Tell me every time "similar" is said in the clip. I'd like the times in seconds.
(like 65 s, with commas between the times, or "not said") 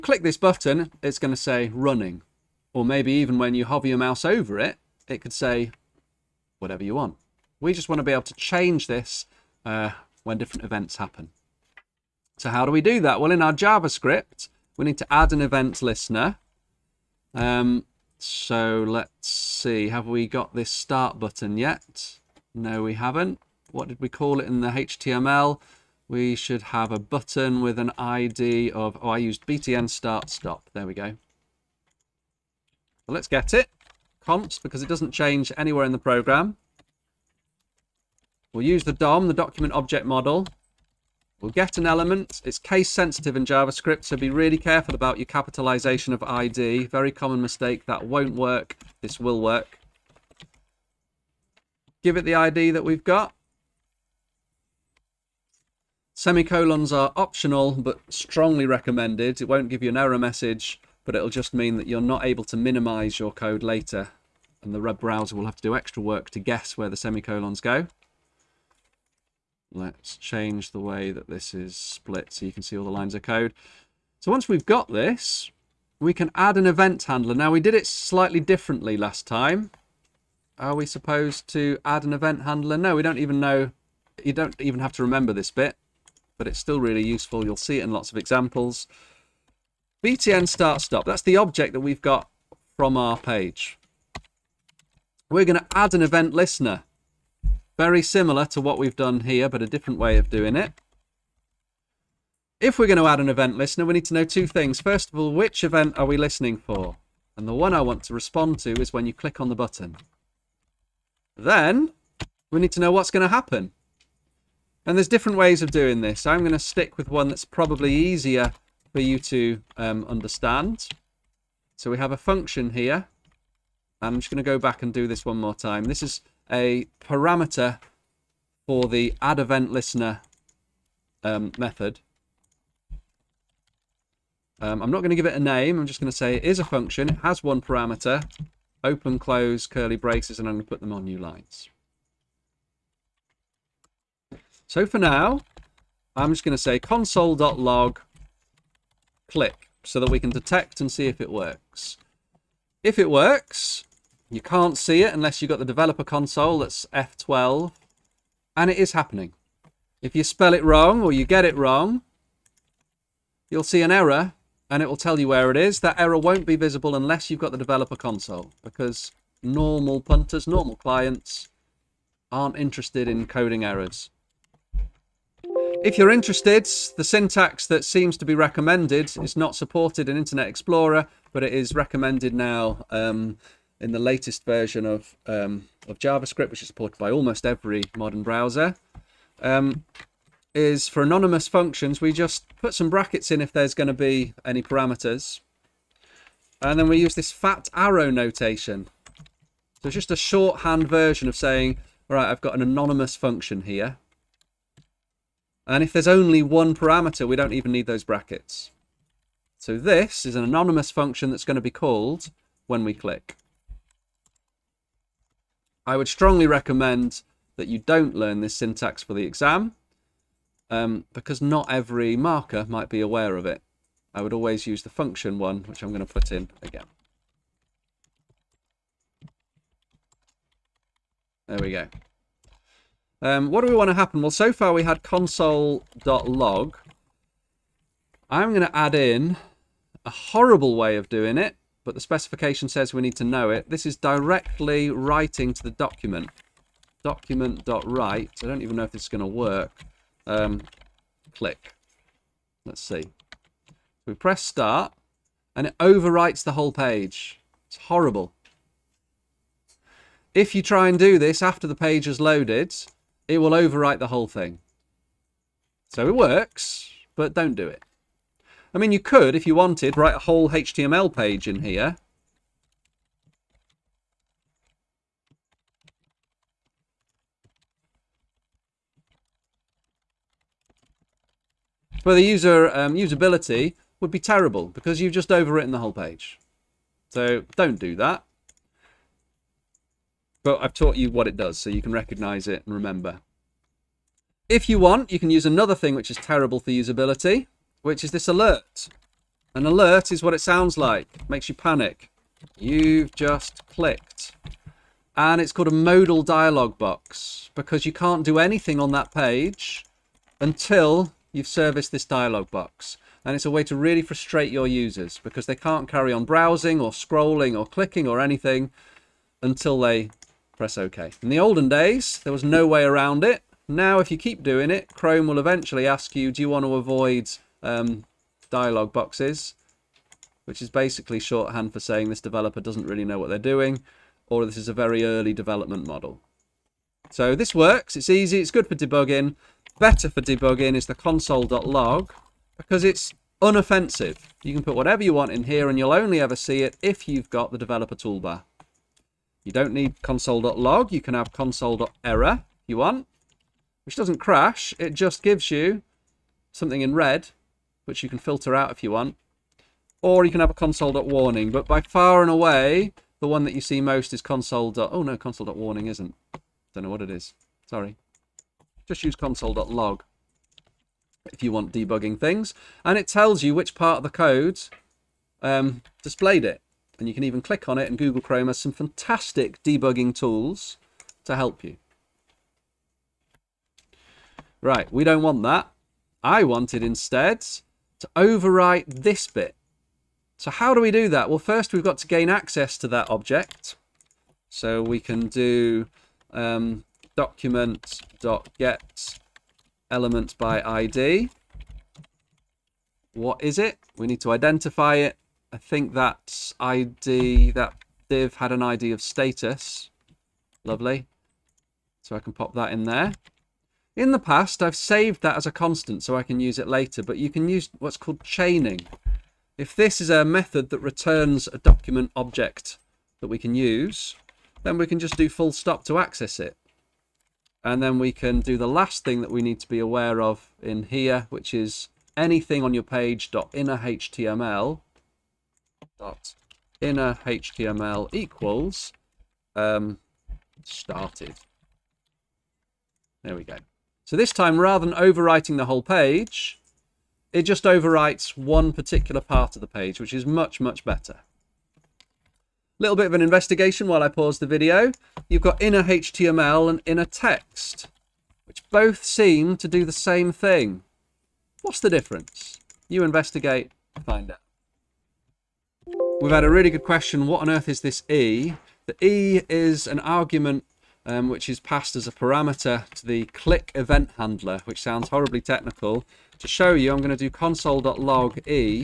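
98 s.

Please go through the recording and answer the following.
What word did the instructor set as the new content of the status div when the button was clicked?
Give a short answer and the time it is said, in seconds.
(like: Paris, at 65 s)
started, at 440 s.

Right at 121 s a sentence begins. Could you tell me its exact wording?
So we have a function here.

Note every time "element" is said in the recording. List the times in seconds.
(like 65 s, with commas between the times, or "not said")
41 s, 399 s.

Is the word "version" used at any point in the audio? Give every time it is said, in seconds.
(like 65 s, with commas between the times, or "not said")
184 s, 200 s.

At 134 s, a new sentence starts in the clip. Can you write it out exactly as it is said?
Um, I'm not going to give it a name.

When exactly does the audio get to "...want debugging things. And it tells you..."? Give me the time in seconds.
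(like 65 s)
371 s.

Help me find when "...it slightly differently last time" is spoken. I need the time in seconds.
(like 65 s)
77 s.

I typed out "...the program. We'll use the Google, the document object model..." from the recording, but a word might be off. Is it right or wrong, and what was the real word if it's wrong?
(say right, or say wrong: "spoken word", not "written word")
wrong: "DOM", not "Google".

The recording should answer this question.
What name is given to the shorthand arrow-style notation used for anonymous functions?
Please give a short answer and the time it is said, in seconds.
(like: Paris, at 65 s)
fat arrow notation, at 197 s.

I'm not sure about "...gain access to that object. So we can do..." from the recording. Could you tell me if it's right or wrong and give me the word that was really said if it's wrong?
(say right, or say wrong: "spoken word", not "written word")
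right.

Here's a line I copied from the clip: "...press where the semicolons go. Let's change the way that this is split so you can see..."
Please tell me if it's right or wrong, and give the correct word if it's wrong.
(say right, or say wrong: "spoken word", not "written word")
wrong: "guess", not "press".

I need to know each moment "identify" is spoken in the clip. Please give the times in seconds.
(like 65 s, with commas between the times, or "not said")
404 s.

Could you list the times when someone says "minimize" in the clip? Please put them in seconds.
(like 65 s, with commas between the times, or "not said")
62 s.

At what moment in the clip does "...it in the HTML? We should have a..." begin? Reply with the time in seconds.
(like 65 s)
24 s.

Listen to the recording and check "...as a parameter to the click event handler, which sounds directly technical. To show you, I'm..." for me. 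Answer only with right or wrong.
wrong.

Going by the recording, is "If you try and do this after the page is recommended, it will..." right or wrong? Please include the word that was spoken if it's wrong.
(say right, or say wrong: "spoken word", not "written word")
wrong: "loaded", not "recommended".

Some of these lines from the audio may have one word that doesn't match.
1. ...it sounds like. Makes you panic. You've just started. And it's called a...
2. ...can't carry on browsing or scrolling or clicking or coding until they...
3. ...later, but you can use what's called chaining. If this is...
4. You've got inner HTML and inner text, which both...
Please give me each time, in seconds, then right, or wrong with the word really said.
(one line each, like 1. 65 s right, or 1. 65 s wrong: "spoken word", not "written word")
1. 300 s wrong: "clicked", not "started"
2. 315 s wrong: "anything", not "coding"
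3. 416 s right
4. 455 s right.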